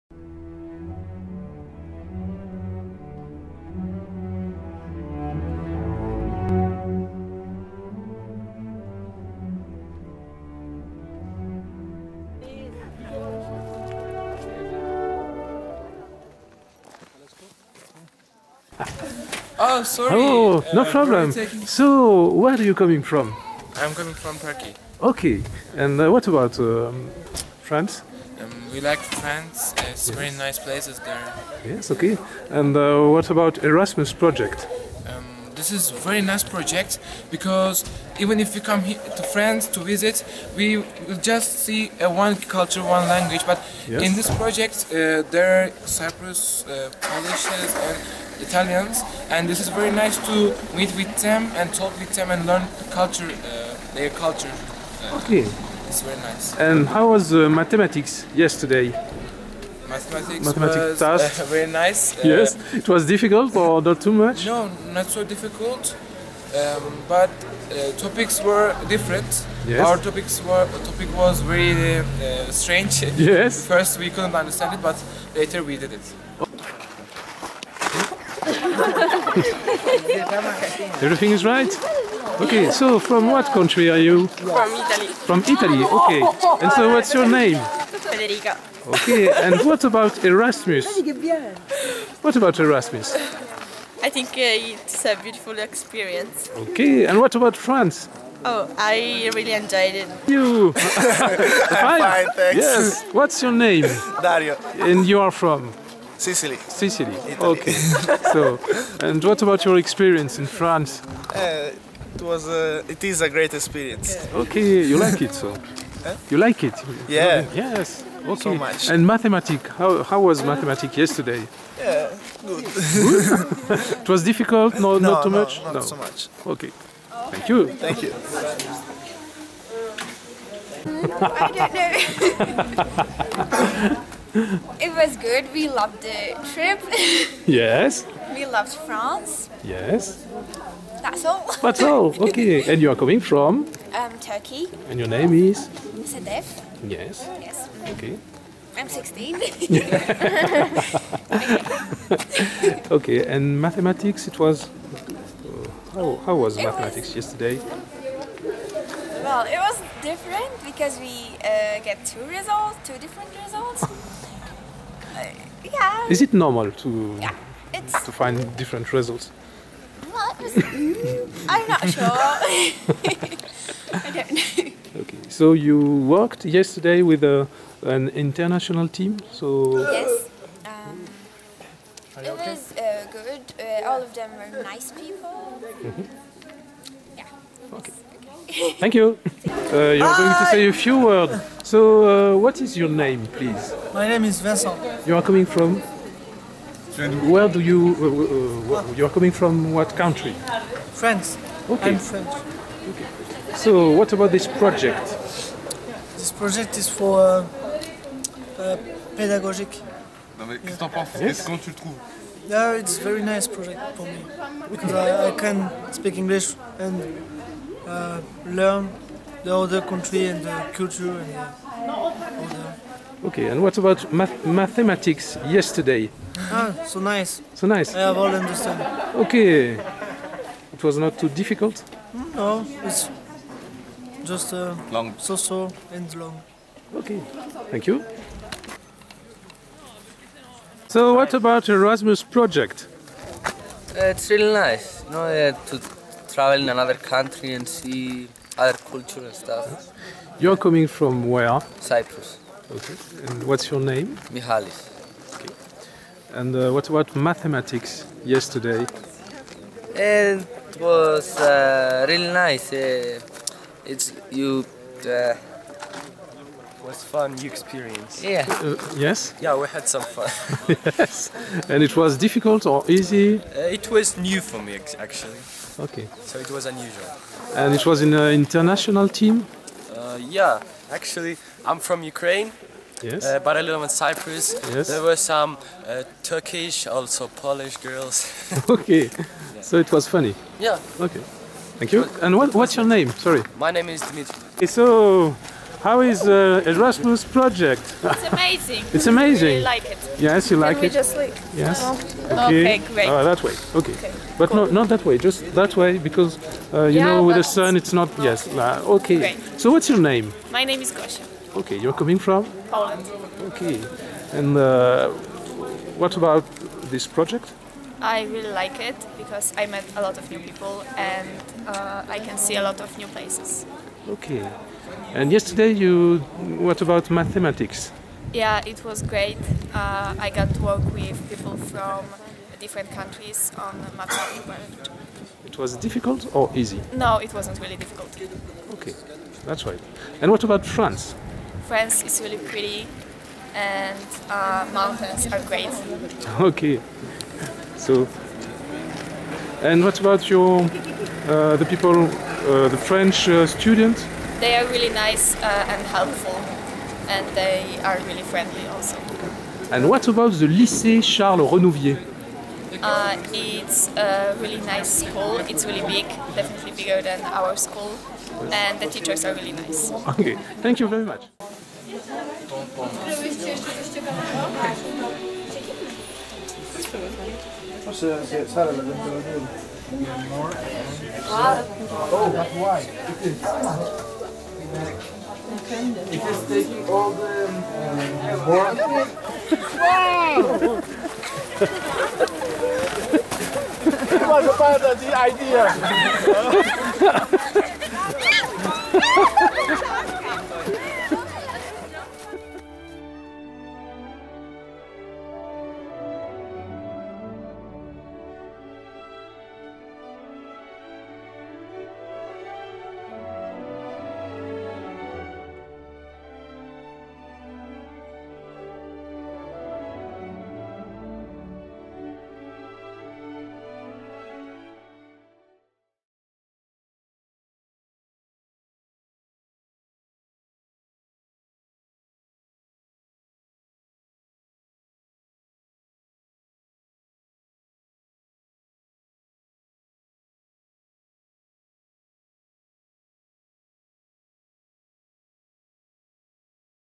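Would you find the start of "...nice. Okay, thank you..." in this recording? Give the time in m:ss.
6:09.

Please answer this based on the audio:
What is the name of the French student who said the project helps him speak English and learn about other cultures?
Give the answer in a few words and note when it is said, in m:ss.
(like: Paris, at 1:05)
Vincent, at 3:13.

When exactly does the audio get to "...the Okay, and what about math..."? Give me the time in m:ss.
3:43.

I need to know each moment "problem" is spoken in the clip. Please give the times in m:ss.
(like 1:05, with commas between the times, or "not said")
0:20.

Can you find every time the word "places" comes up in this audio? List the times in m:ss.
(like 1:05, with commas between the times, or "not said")
0:30, 5:23.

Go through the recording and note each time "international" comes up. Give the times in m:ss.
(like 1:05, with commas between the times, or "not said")
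2:58, 4:38.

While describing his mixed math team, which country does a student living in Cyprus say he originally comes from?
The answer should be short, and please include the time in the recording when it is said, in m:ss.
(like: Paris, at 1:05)
Ukraine, at 4:42.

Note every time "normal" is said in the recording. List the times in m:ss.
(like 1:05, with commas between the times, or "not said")
2:46.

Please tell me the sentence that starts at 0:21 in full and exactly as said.
So, where are you coming from?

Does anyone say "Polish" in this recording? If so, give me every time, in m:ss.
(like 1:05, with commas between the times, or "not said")
0:46, 4:47.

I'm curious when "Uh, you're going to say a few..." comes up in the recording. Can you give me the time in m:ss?
3:09.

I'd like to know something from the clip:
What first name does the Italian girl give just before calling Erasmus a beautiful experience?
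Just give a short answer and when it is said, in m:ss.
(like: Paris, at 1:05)
Federica, at 1:28.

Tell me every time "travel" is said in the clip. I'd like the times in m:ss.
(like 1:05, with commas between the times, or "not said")
4:06.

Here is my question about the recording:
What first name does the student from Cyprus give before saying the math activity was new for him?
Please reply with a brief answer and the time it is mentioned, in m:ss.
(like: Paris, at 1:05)
Mihalis, at 4:14.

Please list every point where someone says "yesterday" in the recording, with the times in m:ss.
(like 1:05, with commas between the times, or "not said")
0:58, 2:00, 2:37, 2:56, 3:45, 4:18, 5:25.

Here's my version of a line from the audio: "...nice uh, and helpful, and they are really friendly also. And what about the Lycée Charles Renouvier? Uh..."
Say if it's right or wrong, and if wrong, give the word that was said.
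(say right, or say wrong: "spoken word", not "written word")
right.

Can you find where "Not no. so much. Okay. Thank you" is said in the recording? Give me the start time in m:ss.
2:05.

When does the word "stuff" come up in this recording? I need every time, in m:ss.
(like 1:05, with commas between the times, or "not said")
4:09.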